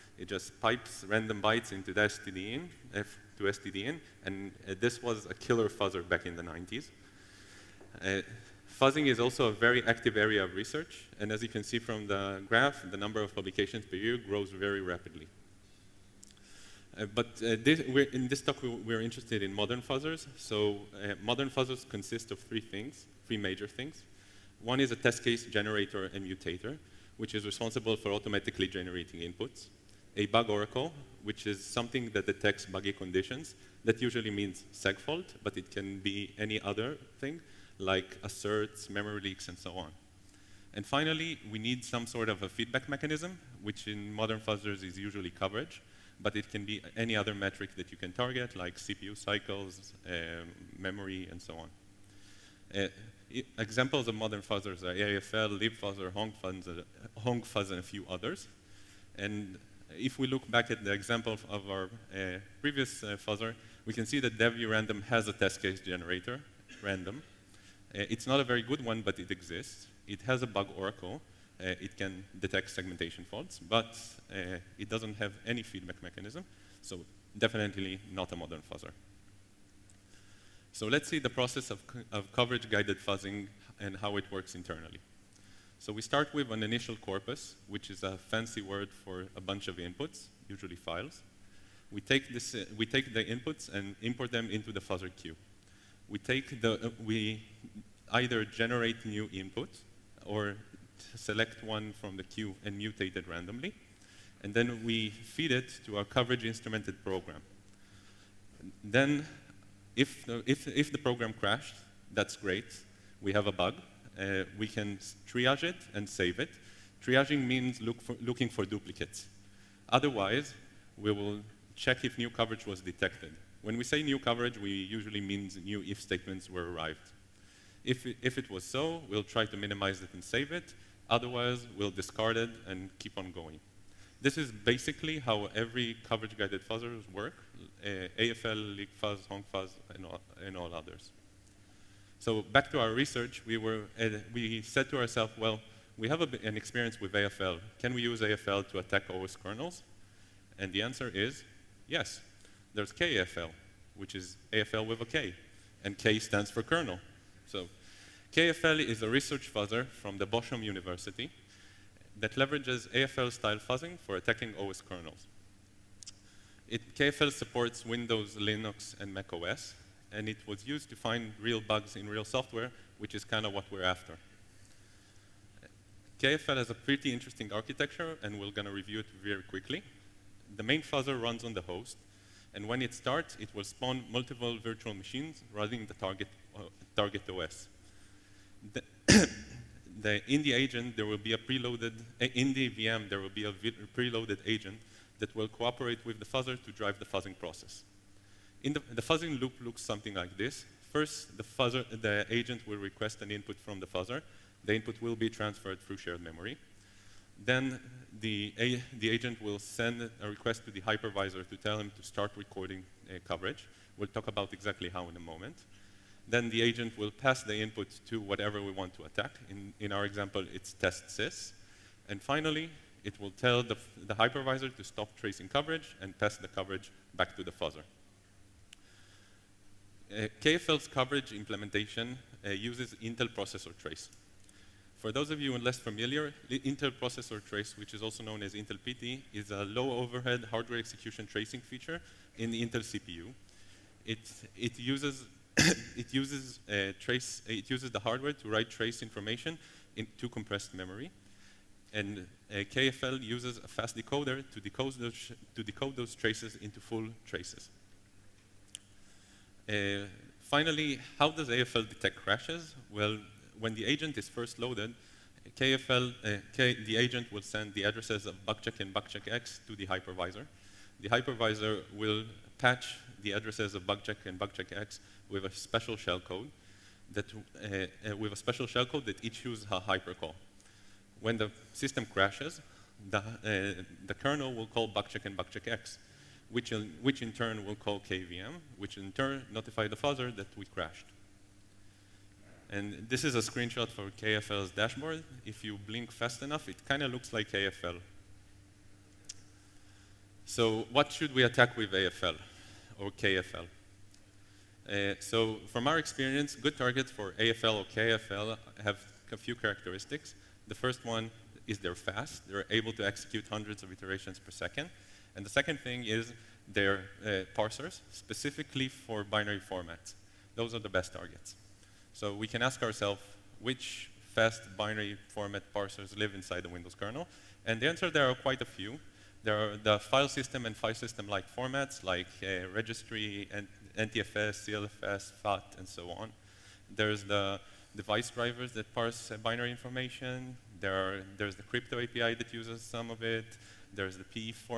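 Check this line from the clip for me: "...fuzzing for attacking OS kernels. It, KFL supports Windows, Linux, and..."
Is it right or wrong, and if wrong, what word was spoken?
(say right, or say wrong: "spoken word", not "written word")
right.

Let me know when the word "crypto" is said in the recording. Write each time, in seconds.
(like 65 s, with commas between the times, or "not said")
341 s.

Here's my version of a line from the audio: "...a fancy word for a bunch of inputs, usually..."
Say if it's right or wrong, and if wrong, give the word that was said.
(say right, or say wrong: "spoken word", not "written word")
right.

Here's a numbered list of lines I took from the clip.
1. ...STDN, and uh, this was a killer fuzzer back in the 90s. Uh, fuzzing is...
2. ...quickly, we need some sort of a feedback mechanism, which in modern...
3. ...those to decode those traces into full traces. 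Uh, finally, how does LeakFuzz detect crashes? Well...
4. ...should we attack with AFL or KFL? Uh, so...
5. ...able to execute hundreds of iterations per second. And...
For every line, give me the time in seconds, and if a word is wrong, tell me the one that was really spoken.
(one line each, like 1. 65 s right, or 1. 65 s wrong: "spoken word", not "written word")
1. 3 s right
2. 40 s wrong: "finally", not "quickly"
3. 254 s wrong: "AFL", not "LeakFuzz"
4. 301 s right
5. 312 s right.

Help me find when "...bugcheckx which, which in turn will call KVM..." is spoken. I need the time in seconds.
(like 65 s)
285 s.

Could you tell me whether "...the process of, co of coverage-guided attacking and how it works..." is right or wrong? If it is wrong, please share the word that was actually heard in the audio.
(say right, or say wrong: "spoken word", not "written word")
wrong: "fuzzing", not "attacking".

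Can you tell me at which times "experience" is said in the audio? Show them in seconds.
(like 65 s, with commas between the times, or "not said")
146 s, 305 s.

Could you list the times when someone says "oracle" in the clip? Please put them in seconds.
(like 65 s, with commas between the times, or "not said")
30 s, 70 s.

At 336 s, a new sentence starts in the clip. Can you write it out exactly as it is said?
There's the device drivers that parse uh, binary information.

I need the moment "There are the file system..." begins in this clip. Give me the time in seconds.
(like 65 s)
329 s.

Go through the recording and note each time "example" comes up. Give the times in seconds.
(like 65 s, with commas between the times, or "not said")
53 s, 60 s, 220 s.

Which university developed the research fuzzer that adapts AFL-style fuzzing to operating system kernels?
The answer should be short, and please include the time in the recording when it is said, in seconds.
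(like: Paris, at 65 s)
Bochum University, at 160 s.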